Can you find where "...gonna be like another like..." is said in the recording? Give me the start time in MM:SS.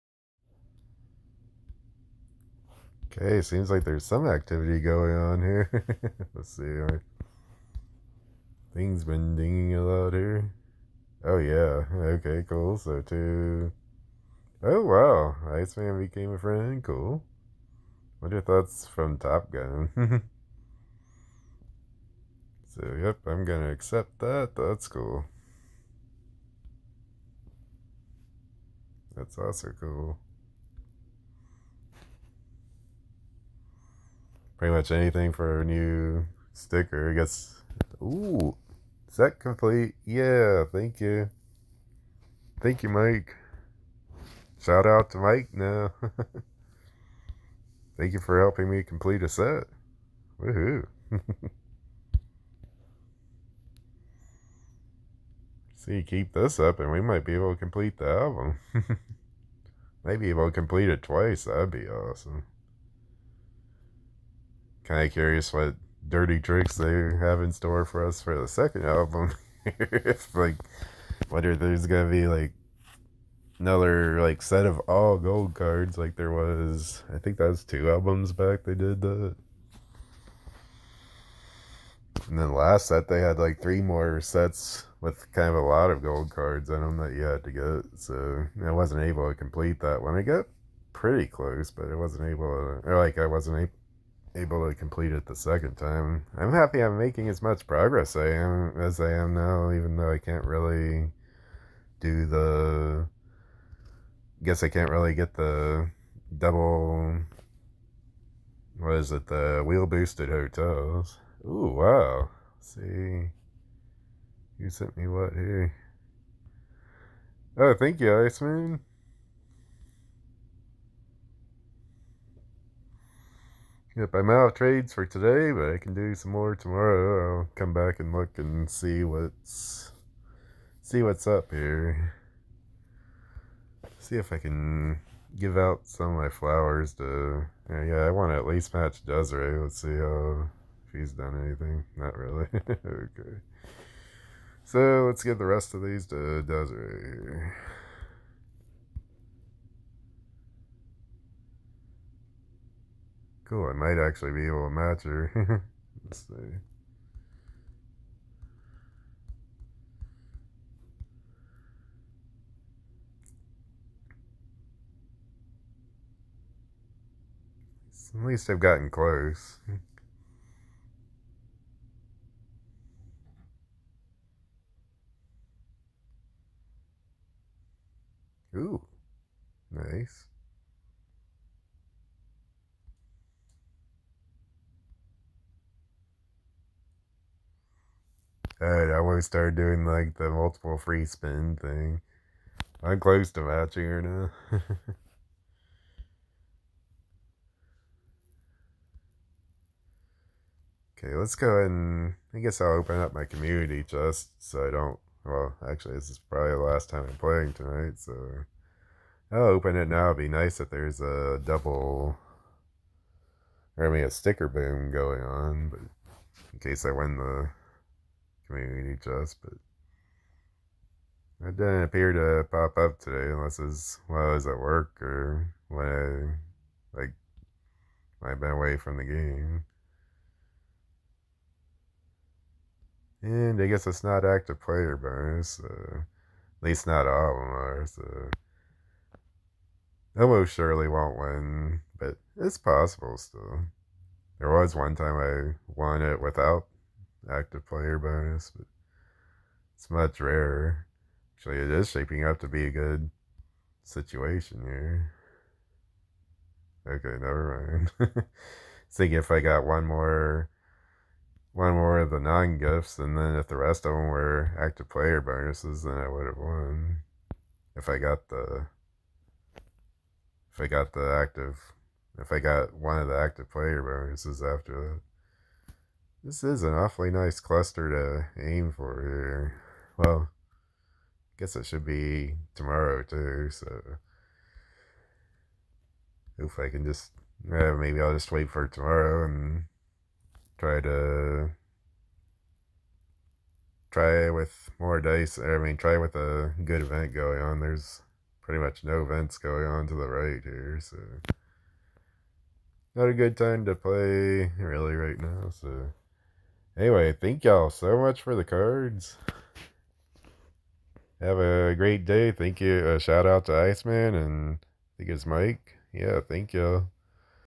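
01:11.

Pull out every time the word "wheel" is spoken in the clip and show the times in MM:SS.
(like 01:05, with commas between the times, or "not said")
01:49.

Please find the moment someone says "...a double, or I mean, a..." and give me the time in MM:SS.
03:30.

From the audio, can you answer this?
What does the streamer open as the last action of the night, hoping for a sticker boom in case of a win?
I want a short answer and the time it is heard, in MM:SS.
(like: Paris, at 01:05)
community chest, at 03:38.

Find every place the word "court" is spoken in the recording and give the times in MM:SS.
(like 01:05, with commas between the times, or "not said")
not said.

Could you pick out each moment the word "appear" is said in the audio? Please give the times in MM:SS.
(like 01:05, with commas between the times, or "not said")
03:41.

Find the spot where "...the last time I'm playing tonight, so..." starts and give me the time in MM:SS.
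03:26.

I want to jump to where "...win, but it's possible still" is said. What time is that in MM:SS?
04:01.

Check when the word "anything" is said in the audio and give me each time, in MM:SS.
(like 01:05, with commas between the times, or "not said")
00:34, 02:21.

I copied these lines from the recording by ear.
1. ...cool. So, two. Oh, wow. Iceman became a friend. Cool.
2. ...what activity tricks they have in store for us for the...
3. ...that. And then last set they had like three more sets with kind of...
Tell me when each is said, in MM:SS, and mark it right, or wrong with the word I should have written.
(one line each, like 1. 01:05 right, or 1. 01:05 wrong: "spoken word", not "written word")
1. 00:12 right
2. 01:05 wrong: "dirty", not "activity"
3. 01:19 right.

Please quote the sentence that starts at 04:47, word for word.
maybe I'll just wait for tomorrow and try to...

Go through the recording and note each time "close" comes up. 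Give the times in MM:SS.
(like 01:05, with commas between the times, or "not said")
01:31, 02:48, 03:12.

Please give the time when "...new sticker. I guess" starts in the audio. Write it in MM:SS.
00:35.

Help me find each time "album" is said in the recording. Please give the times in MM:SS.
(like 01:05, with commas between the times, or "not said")
00:58, 01:08, 01:17.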